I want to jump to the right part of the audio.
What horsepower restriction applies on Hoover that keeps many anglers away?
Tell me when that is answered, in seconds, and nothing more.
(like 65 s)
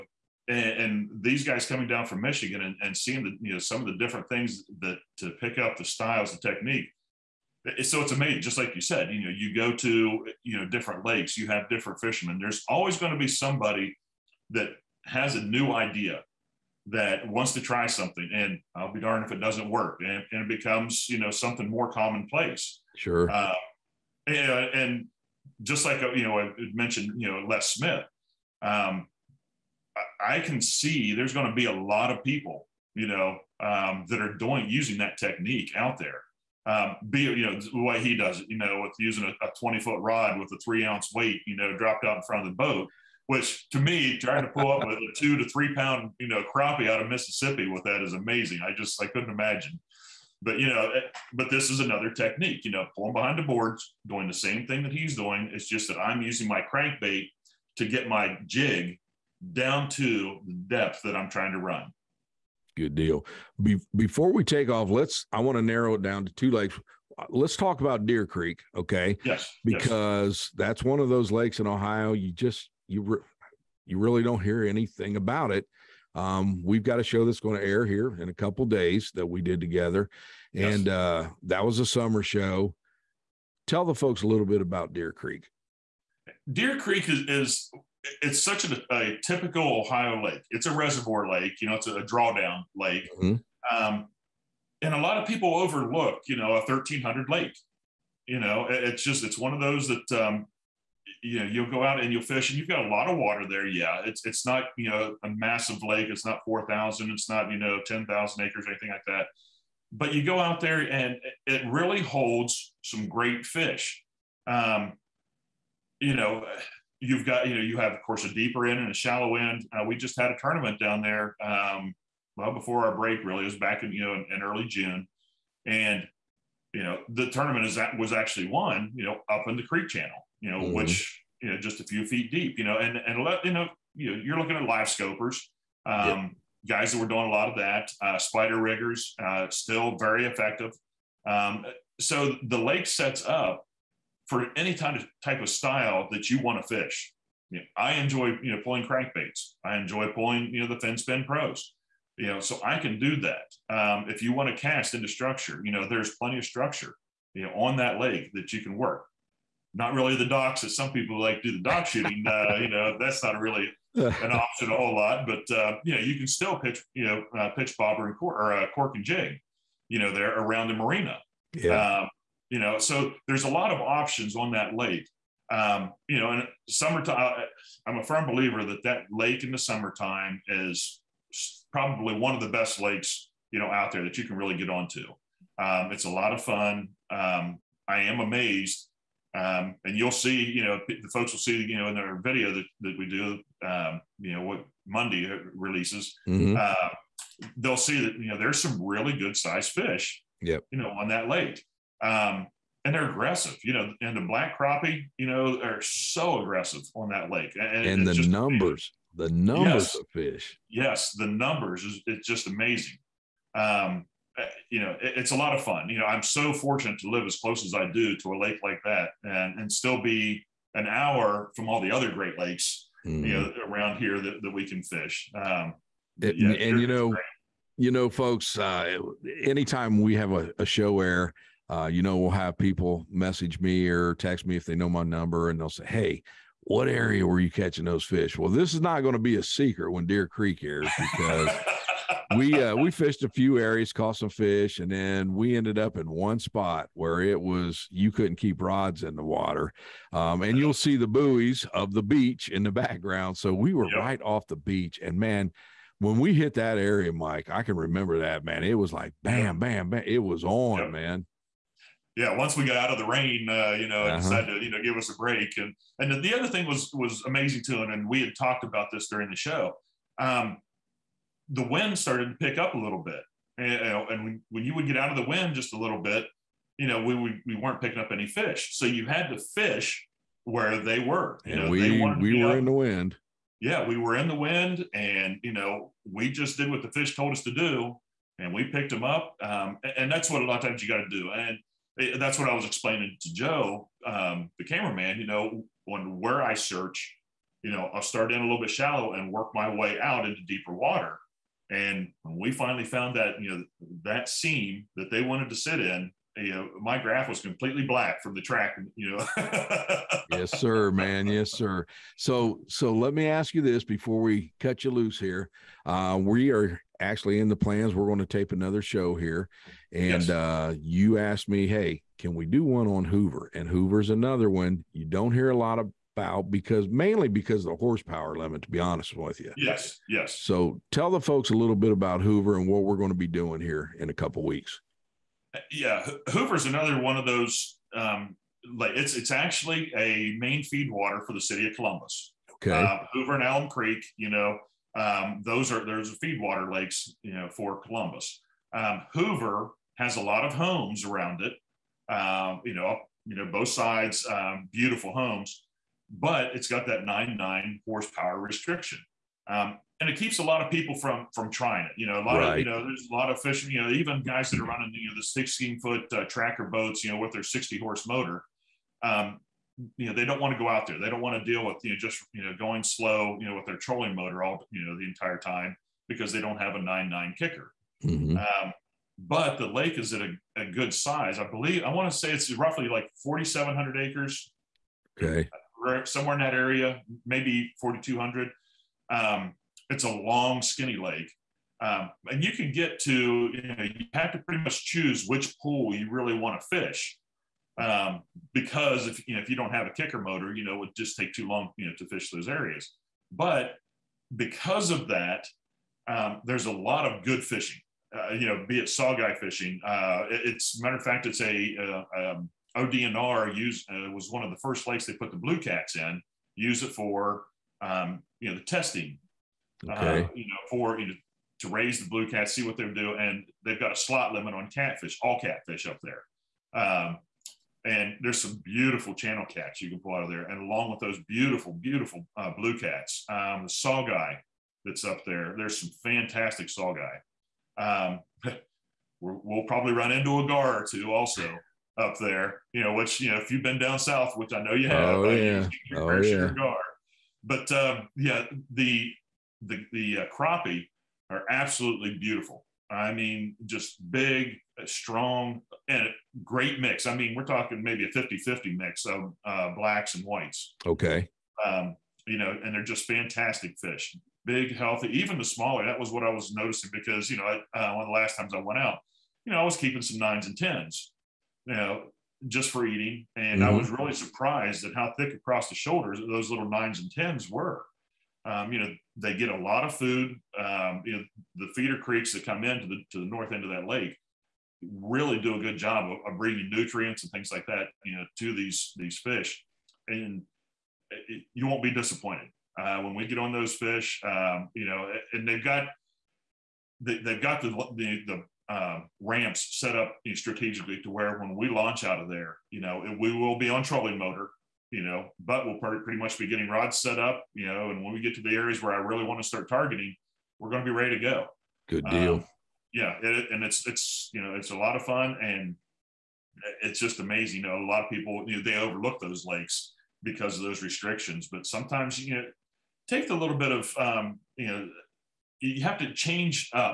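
357 s.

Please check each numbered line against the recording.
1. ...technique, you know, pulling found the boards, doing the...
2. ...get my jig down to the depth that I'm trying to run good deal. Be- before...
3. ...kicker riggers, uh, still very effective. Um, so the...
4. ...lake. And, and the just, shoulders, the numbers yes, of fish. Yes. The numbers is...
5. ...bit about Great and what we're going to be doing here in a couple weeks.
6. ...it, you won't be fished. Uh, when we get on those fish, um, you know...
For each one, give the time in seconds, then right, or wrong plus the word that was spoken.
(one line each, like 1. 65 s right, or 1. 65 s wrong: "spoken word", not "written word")
1. 52 s wrong: "behind", not "found"
2. 57 s right
3. 138 s wrong: "spider", not "kicker"
4. 207 s wrong: "numbers", not "shoulders"
5. 331 s wrong: "Hoover", not "Great"
6. 491 s wrong: "disappointed", not "fished".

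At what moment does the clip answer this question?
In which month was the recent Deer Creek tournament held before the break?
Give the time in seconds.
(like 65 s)
124 s.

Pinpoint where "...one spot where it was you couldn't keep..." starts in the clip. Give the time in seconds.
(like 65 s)
246 s.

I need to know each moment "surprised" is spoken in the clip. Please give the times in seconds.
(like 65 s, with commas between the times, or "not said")
474 s.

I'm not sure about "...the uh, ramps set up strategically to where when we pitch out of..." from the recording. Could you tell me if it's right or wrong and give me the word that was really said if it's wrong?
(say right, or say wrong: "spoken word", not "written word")
wrong: "launch", not "pitch".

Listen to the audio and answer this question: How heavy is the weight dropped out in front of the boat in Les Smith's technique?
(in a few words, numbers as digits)
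3 ounce.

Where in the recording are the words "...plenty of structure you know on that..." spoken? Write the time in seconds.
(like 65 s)
156 s.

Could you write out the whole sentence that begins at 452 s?
I mean, just big, uh, strong, and great mix.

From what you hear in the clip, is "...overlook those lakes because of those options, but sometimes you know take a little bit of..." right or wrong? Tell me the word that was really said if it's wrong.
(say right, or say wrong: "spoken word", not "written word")
wrong: "restrictions", not "options".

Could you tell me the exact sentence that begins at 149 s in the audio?
I enjoy pulling you know the fin spin pros.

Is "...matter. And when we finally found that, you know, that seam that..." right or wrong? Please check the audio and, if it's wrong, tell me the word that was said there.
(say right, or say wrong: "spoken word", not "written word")
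wrong: "water", not "matter".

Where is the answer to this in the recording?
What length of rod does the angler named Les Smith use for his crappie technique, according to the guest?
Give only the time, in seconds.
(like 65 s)
39 s.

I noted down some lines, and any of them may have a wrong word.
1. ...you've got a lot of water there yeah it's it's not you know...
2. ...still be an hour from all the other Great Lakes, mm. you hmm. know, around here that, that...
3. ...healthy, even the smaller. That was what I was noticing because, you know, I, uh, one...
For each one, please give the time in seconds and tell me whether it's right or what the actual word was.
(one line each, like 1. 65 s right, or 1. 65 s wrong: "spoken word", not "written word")
1. 102 s right
2. 219 s right
3. 464 s right.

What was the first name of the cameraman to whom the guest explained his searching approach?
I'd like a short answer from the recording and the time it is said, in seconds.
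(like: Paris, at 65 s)
Joe, at 293 s.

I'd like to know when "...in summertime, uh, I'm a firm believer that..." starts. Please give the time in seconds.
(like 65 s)
176 s.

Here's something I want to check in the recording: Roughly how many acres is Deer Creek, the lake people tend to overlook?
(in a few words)
1,300.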